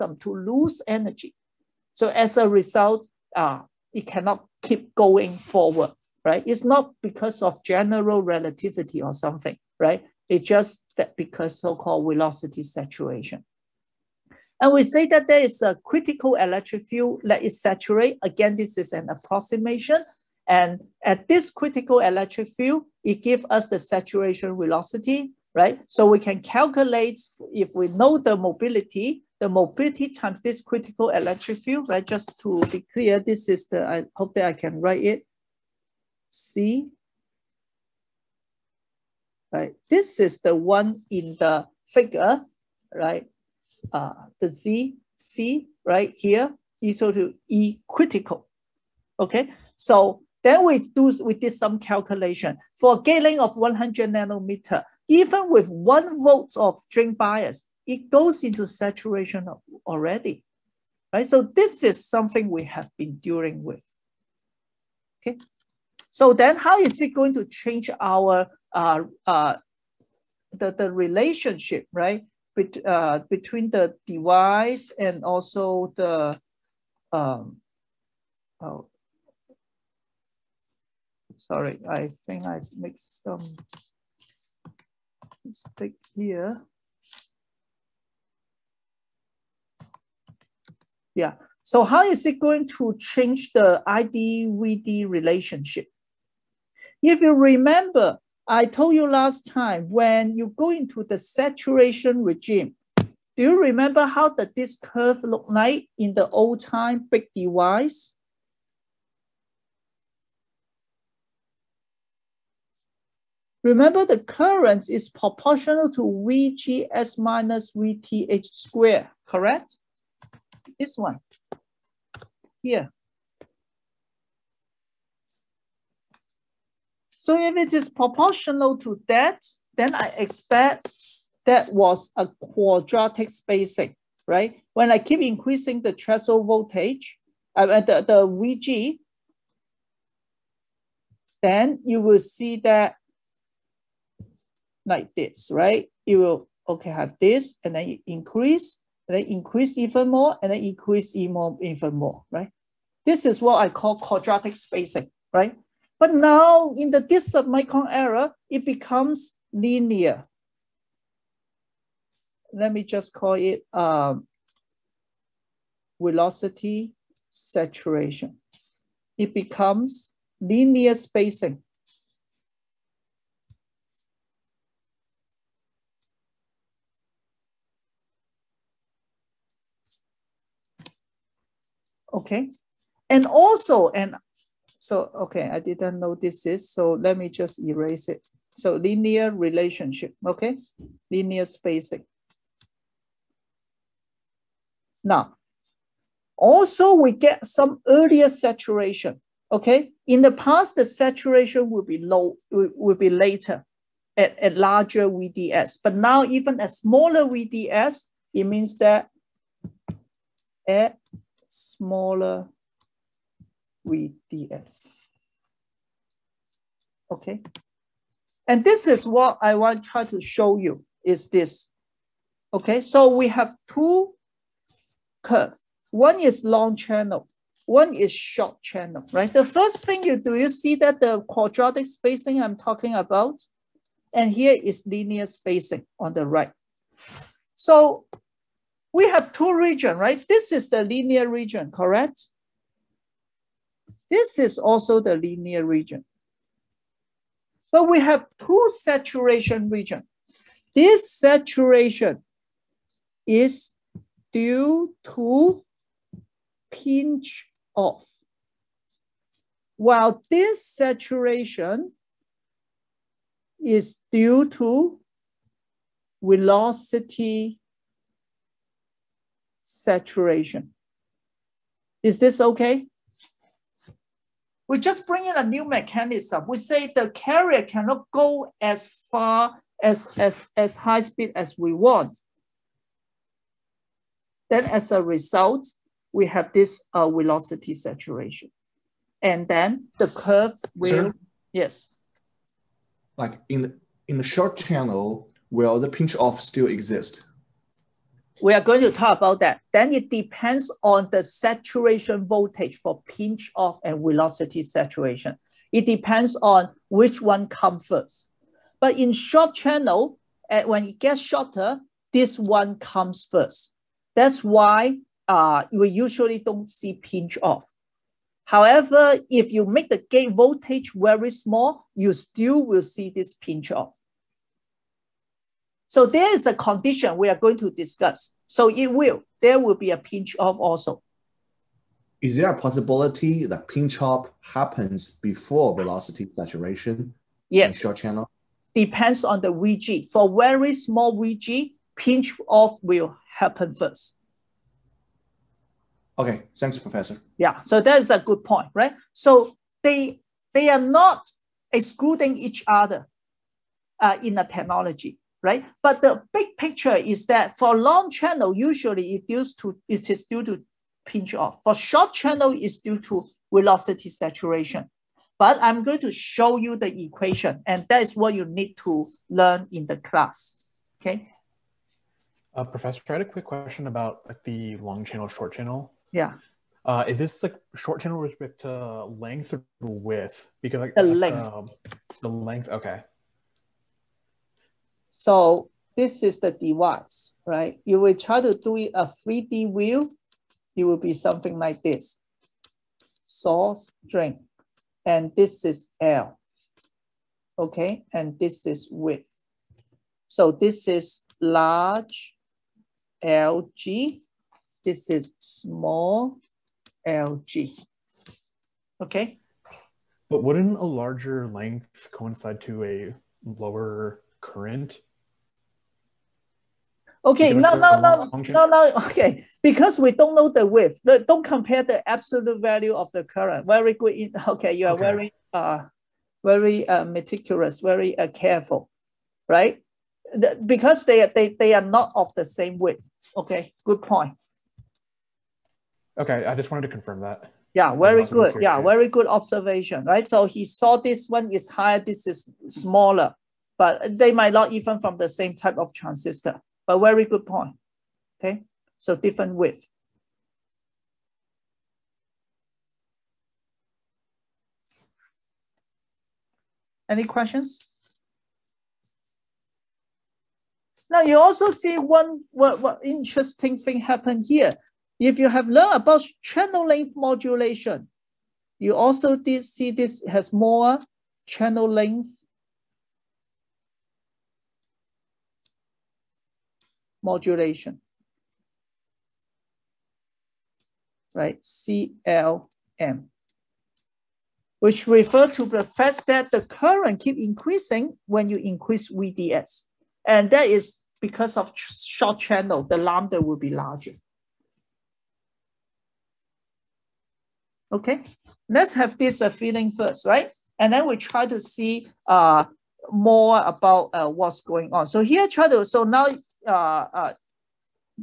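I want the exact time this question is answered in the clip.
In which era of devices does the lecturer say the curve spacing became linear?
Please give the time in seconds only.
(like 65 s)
157 s.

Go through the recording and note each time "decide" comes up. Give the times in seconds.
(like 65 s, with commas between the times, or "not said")
not said.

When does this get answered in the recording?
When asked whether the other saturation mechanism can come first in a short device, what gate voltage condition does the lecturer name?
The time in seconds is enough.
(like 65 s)
340 s.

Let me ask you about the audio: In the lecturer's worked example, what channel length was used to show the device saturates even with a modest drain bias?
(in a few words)
100 nanometer.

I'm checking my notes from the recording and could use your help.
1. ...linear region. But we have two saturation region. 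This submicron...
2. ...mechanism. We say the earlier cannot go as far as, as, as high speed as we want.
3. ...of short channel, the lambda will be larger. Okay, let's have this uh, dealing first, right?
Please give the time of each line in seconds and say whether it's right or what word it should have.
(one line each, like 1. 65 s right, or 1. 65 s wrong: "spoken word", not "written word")
1. 245 s wrong: "saturation", not "submicron"
2. 275 s wrong: "carrier", not "earlier"
3. 491 s wrong: "feeling", not "dealing".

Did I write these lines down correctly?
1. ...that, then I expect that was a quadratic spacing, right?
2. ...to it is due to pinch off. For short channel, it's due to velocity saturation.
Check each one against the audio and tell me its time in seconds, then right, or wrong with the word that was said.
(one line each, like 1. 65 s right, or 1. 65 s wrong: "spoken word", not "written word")
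1. 129 s right
2. 359 s right.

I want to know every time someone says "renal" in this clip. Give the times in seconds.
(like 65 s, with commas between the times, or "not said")
not said.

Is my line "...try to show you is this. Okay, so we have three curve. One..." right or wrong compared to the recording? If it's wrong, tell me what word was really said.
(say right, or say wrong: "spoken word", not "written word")
wrong: "two", not "three".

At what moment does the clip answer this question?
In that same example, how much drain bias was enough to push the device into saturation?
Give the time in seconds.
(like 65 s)
55 s.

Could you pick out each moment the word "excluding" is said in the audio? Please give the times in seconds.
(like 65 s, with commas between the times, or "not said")
351 s.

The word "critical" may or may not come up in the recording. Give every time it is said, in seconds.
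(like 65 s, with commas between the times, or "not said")
15 s, 21 s, 30 s, 47 s.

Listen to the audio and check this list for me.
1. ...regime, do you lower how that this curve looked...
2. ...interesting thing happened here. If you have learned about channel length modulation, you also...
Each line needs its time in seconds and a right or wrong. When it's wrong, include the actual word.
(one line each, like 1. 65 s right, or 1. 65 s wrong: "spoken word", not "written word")
1. 102 s wrong: "remember", not "lower"
2. 463 s right.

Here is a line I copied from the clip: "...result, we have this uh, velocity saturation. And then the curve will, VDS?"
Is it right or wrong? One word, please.
wrong.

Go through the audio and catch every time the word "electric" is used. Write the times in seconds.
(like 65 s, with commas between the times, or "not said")
16 s, 21 s, 31 s.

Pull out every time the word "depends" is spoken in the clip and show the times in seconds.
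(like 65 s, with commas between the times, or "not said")
300 s, 305 s, 338 s.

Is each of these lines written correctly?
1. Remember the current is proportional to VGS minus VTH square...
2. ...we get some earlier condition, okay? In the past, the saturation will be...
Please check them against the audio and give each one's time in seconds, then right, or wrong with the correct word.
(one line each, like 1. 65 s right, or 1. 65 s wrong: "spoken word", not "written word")
1. 113 s right
2. 196 s wrong: "saturation", not "condition".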